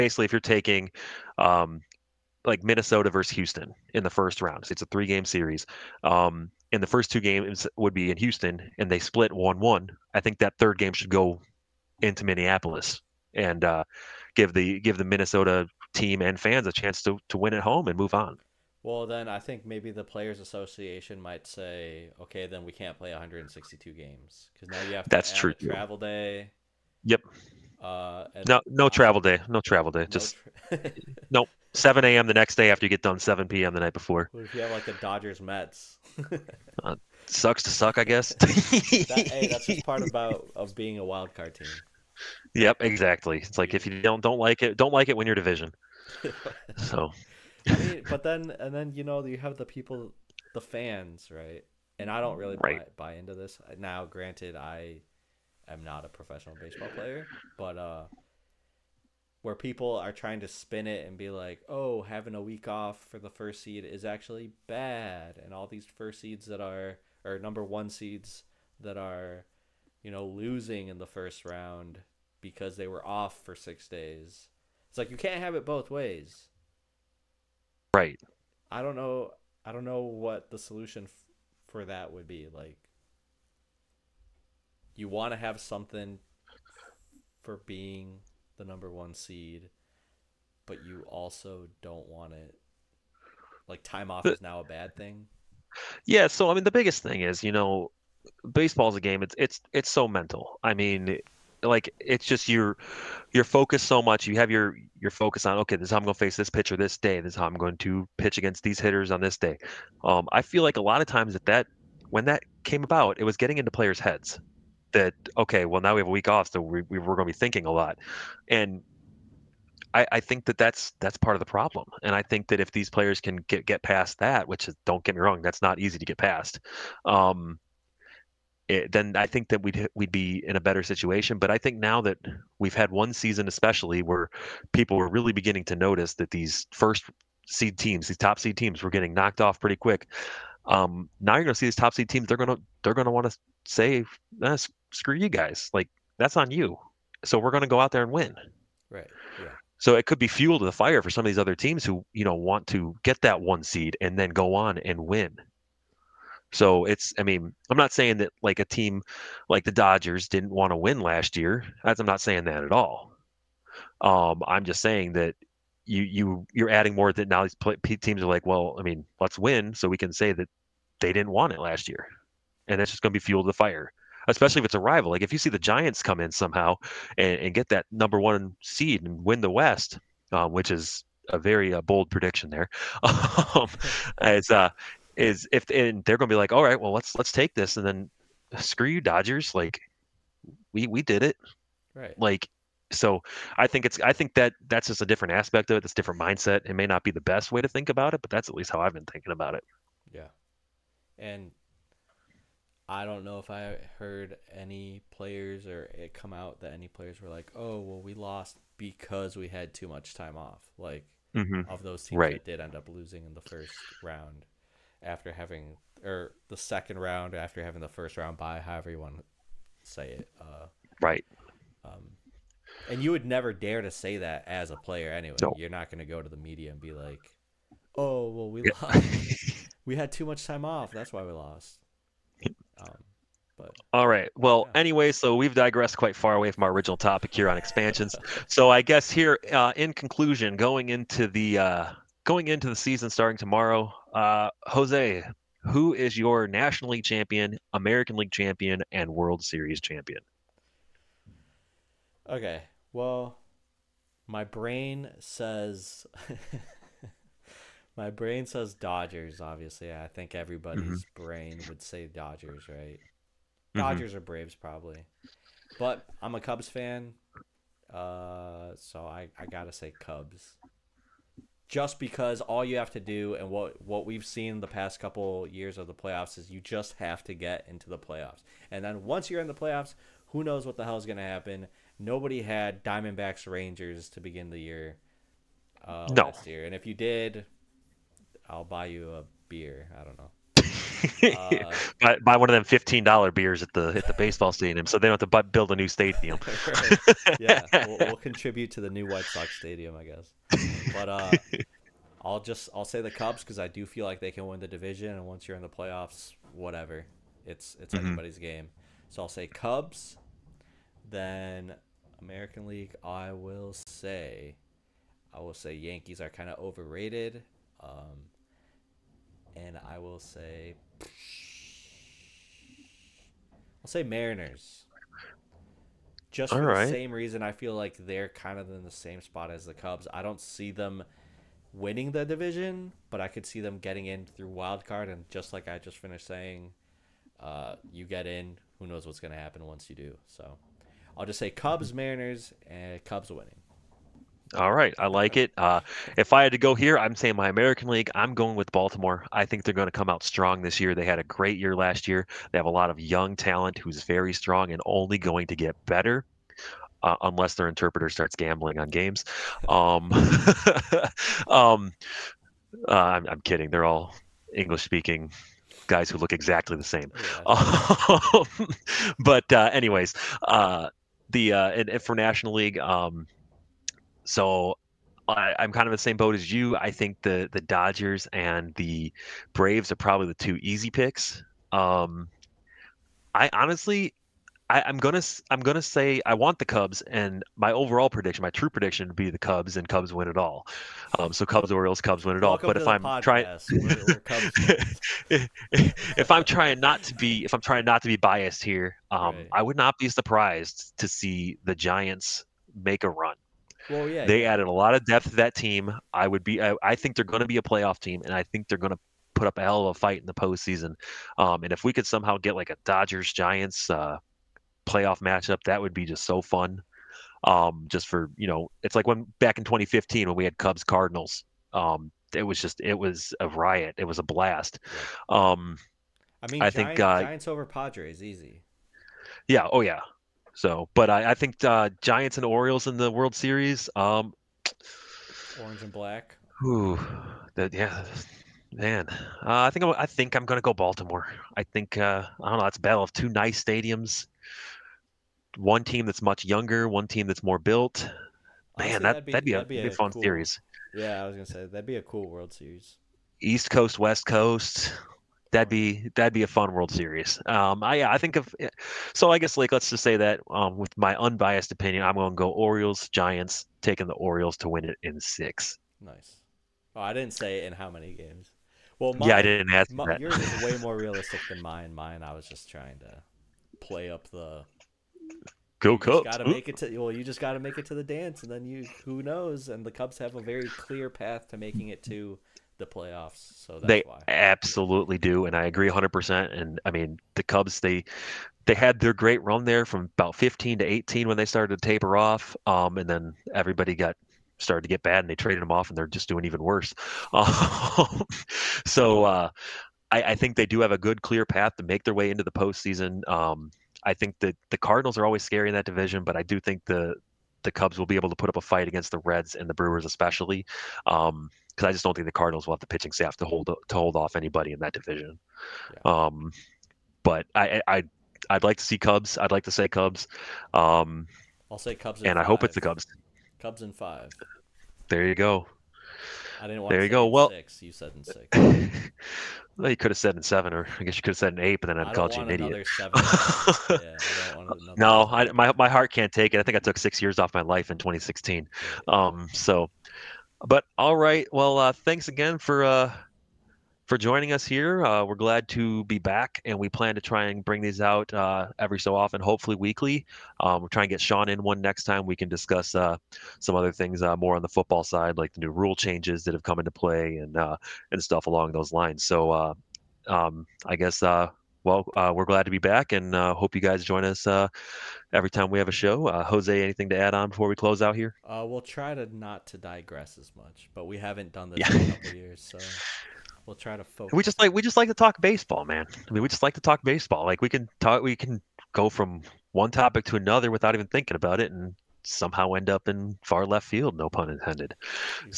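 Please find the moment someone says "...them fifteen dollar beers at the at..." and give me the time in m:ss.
4:52.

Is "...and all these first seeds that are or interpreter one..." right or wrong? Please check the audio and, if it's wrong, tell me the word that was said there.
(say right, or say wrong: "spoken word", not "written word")
wrong: "number", not "interpreter".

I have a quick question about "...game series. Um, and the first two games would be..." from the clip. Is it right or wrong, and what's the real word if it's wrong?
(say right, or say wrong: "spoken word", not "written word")
right.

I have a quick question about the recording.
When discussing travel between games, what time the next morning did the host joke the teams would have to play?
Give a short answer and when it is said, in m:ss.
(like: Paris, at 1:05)
7 a.m., at 0:31.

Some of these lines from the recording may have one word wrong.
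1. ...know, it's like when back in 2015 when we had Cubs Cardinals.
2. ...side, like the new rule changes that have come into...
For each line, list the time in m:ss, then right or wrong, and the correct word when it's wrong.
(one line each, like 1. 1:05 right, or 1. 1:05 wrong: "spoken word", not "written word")
1. 6:58 right
2. 9:15 right.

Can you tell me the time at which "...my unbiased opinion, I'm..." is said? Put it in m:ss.
7:40.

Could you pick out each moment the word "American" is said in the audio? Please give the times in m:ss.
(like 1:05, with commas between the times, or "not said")
4:07, 5:12, 5:47.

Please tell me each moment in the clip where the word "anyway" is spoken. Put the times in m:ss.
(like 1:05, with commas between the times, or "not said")
3:45, 3:54, 6:09.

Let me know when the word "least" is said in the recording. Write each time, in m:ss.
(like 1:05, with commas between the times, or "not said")
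3:18.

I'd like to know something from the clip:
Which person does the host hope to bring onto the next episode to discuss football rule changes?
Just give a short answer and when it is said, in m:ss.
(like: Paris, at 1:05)
Sean, at 9:11.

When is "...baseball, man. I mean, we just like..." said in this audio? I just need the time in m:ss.
9:35.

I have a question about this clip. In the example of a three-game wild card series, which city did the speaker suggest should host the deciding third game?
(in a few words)
Minneapolis.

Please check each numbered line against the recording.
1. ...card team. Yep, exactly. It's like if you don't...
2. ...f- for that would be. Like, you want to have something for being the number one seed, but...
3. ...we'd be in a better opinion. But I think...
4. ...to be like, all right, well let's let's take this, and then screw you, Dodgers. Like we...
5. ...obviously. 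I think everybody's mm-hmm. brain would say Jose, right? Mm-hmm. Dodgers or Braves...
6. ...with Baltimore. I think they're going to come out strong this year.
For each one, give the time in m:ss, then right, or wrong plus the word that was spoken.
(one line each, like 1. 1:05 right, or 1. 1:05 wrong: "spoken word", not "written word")
1. 0:41 right
2. 1:21 right
3. 2:09 wrong: "situation", not "opinion"
4. 3:06 right
5. 4:19 wrong: "Dodgers", not "Jose"
6. 5:48 right.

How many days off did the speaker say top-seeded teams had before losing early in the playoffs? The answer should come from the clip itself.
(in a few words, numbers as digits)
6.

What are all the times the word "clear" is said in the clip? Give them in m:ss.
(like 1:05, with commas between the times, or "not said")
8:00, 8:21.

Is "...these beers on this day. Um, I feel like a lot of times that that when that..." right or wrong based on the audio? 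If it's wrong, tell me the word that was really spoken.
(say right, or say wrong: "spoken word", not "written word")
wrong: "hitters", not "beers".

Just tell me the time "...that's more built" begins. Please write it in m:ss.
7:27.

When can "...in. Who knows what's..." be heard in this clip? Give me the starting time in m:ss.
5:38.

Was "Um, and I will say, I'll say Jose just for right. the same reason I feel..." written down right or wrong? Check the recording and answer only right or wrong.
wrong.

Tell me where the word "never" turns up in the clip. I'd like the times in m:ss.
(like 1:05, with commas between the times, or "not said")
3:43.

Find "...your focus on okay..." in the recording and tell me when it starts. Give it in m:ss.
1:44.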